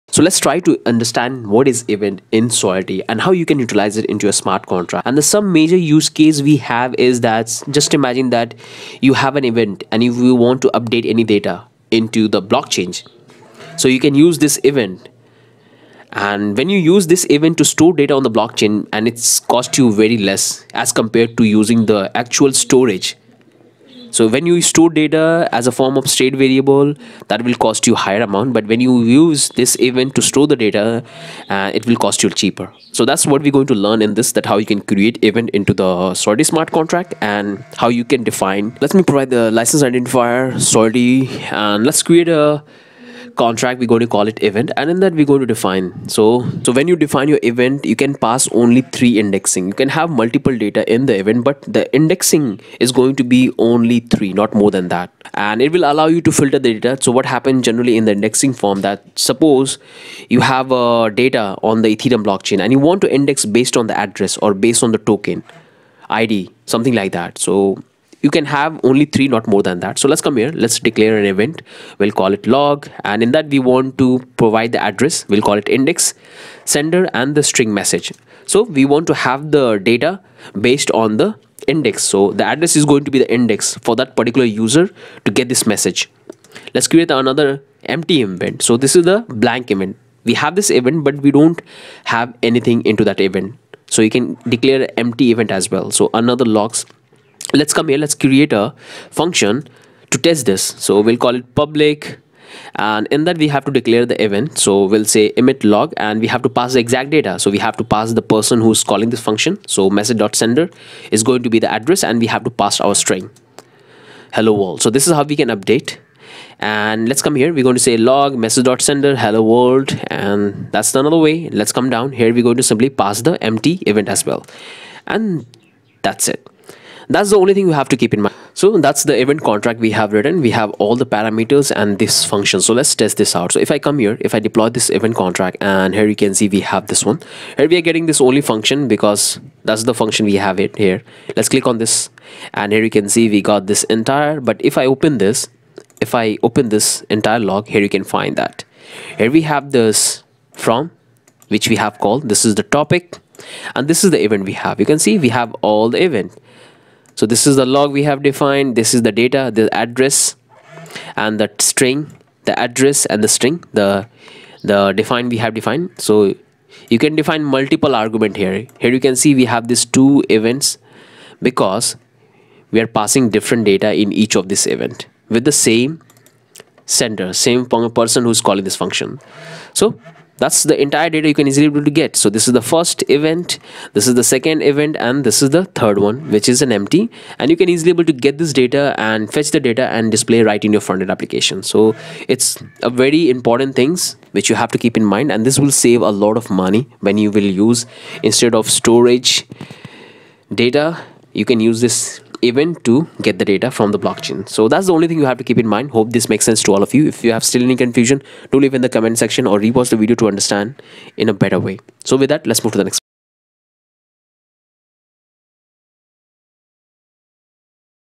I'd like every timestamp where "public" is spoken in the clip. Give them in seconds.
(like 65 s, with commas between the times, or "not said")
101 s.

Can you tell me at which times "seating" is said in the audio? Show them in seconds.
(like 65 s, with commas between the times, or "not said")
not said.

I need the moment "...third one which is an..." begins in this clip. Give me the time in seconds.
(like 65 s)
185 s.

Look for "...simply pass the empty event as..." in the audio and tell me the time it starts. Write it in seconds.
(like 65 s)
122 s.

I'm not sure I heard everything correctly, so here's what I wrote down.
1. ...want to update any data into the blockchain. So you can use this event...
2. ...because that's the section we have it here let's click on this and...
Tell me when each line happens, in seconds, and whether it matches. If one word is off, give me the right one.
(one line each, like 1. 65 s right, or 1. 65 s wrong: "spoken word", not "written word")
1. 10 s right
2. 138 s wrong: "function", not "section".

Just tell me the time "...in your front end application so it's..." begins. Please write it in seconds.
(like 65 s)
190 s.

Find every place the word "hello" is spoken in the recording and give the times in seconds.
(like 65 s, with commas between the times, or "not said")
114 s, 119 s.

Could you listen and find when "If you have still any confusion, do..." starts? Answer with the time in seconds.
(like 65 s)
207 s.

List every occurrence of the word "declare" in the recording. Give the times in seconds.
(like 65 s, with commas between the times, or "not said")
70 s, 94 s, 103 s.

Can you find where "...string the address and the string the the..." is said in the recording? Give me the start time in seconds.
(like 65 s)
161 s.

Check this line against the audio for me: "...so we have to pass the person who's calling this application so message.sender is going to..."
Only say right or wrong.
wrong.